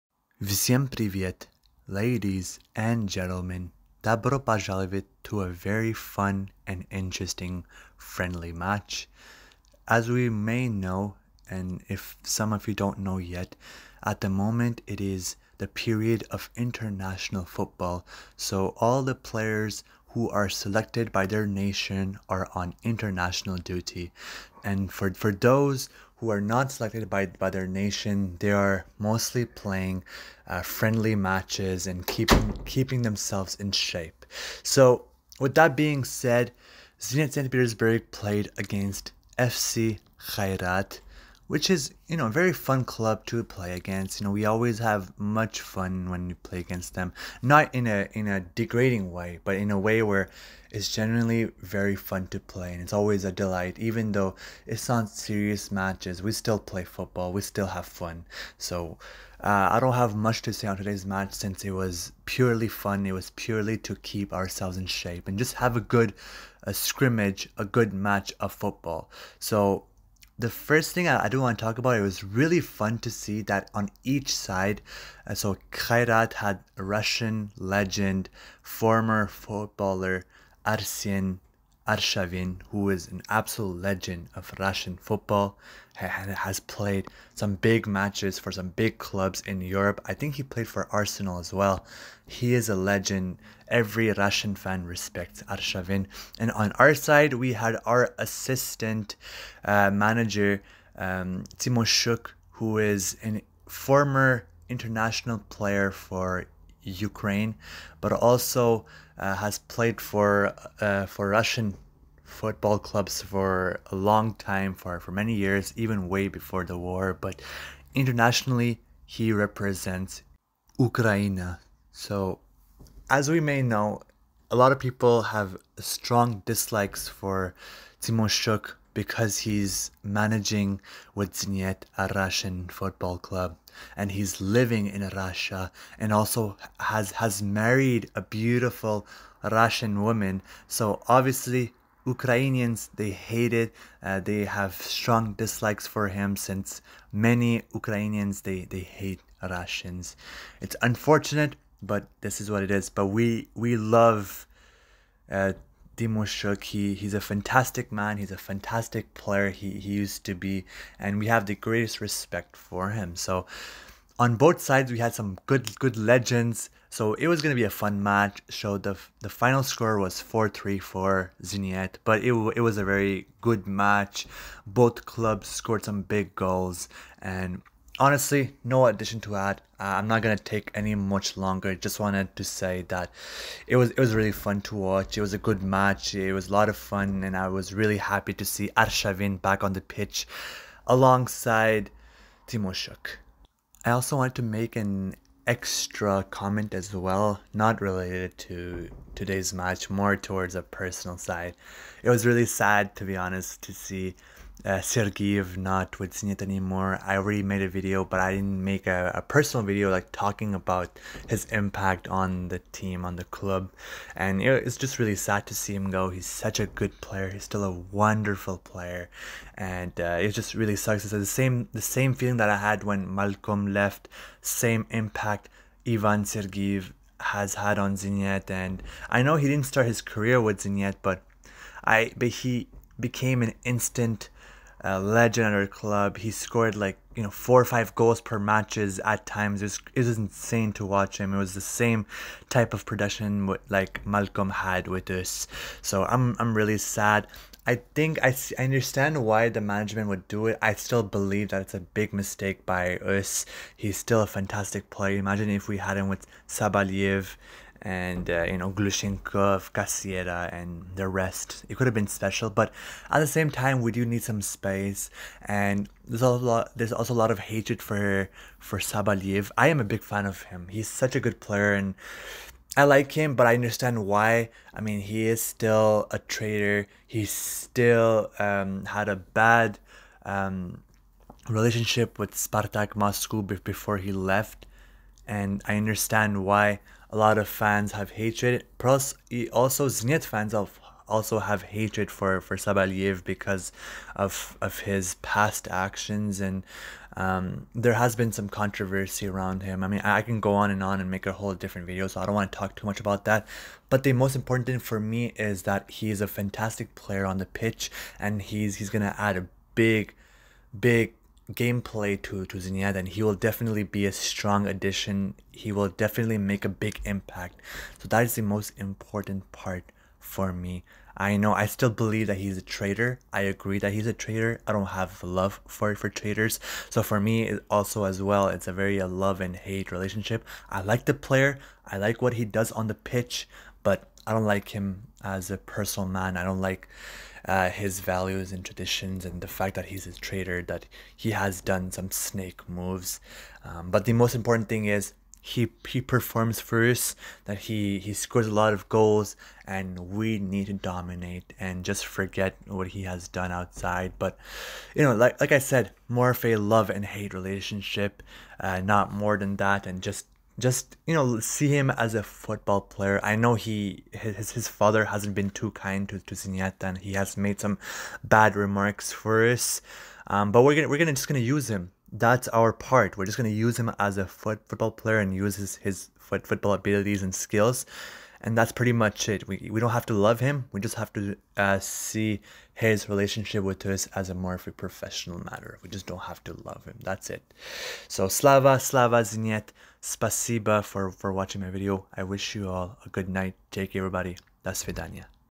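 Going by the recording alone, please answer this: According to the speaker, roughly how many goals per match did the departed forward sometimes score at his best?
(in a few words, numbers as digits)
4 or 5.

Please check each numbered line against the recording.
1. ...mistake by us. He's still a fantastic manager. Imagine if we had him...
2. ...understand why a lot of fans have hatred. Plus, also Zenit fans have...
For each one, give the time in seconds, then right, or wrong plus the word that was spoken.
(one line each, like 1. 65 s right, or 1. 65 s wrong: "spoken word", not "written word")
1. 252 s wrong: "player", not "manager"
2. 285 s right.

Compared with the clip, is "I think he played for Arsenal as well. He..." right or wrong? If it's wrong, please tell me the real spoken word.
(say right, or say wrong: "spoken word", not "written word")
right.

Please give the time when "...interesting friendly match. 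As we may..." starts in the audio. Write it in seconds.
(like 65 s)
6 s.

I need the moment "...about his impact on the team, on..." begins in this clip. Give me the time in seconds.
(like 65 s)
210 s.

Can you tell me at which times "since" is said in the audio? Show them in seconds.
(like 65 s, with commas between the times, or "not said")
61 s, 146 s.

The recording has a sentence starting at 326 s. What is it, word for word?
So for me, also as well, it's a very a uh, love and hate relationship.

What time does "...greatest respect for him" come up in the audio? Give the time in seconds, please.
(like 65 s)
161 s.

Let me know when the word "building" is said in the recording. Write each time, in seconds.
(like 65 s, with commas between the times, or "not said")
not said.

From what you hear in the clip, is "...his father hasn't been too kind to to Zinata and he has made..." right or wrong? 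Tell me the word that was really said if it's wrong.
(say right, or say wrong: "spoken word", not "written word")
right.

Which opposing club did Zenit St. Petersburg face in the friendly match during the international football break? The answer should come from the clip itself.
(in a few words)
FC Kairat.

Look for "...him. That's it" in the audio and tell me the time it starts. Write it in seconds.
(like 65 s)
386 s.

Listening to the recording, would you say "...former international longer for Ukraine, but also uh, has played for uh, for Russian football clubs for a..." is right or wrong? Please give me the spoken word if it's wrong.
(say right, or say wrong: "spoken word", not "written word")
wrong: "player", not "longer".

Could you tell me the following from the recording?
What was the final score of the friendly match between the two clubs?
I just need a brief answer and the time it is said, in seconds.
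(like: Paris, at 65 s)
4-3, at 170 s.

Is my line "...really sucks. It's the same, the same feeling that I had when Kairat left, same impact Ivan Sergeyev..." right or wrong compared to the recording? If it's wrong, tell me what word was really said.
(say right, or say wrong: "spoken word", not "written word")
wrong: "Malcom", not "Kairat".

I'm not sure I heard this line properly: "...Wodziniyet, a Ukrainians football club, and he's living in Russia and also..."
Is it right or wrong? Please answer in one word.
wrong.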